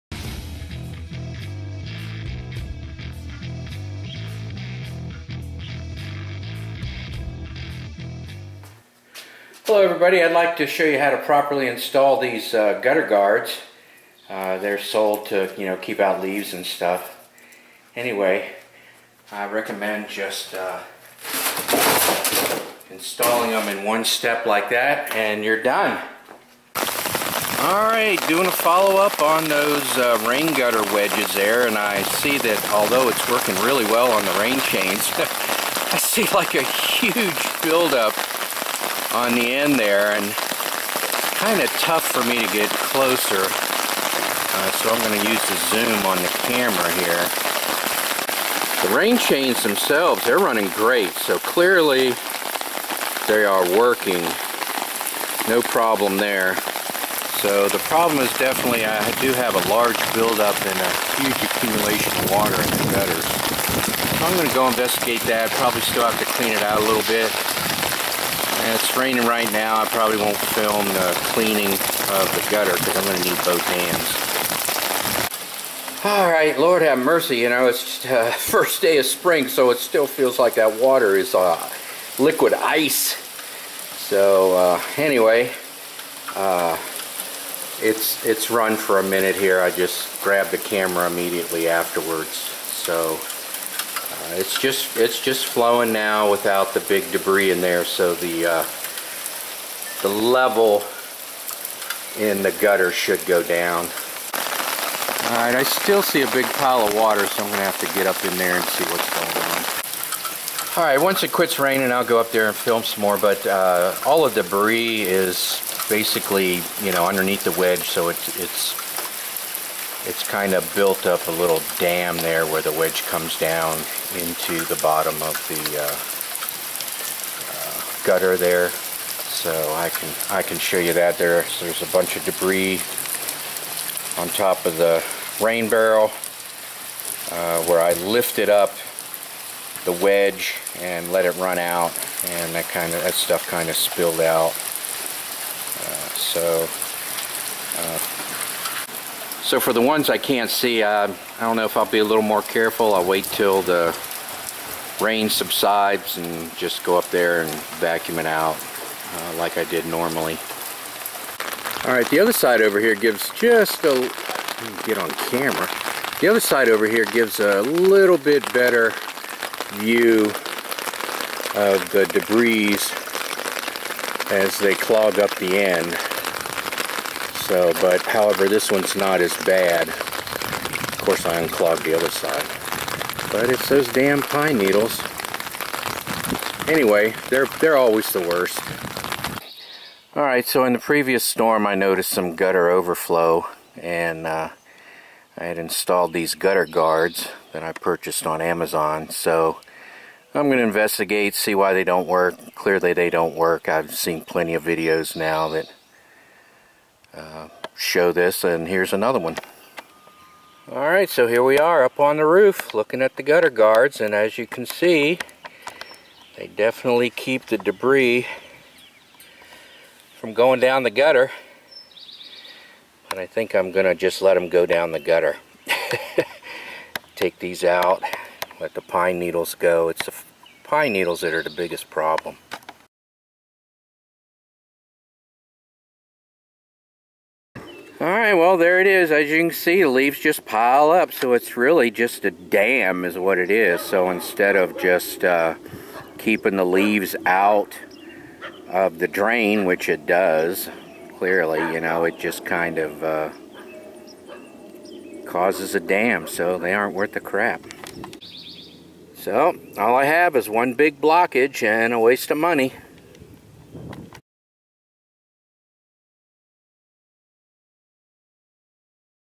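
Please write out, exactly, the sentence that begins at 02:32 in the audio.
I'll wait till the rain subsides and just go up there and vacuum it out uh, like I did normally.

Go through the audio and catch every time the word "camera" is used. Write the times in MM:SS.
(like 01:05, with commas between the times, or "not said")
00:46, 01:30, 02:45.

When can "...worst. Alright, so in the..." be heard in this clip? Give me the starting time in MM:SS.
03:08.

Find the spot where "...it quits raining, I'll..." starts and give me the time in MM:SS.
01:51.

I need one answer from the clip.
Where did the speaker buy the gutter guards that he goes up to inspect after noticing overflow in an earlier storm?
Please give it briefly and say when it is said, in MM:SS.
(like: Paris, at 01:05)
Amazon, at 03:18.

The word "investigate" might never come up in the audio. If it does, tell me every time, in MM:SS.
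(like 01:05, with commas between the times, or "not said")
01:04, 03:20.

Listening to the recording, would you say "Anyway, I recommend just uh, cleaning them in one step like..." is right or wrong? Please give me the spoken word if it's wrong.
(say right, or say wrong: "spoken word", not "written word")
wrong: "installing", not "cleaning".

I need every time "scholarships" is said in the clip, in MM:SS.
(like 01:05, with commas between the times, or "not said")
not said.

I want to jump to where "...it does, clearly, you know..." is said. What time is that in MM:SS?
04:09.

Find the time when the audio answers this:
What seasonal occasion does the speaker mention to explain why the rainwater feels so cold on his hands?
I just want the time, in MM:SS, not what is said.
01:18.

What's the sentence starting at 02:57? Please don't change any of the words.
So, but however, this one's not as bad.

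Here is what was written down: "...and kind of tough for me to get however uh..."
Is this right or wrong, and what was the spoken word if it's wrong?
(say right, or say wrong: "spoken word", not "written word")
wrong: "closer", not "however".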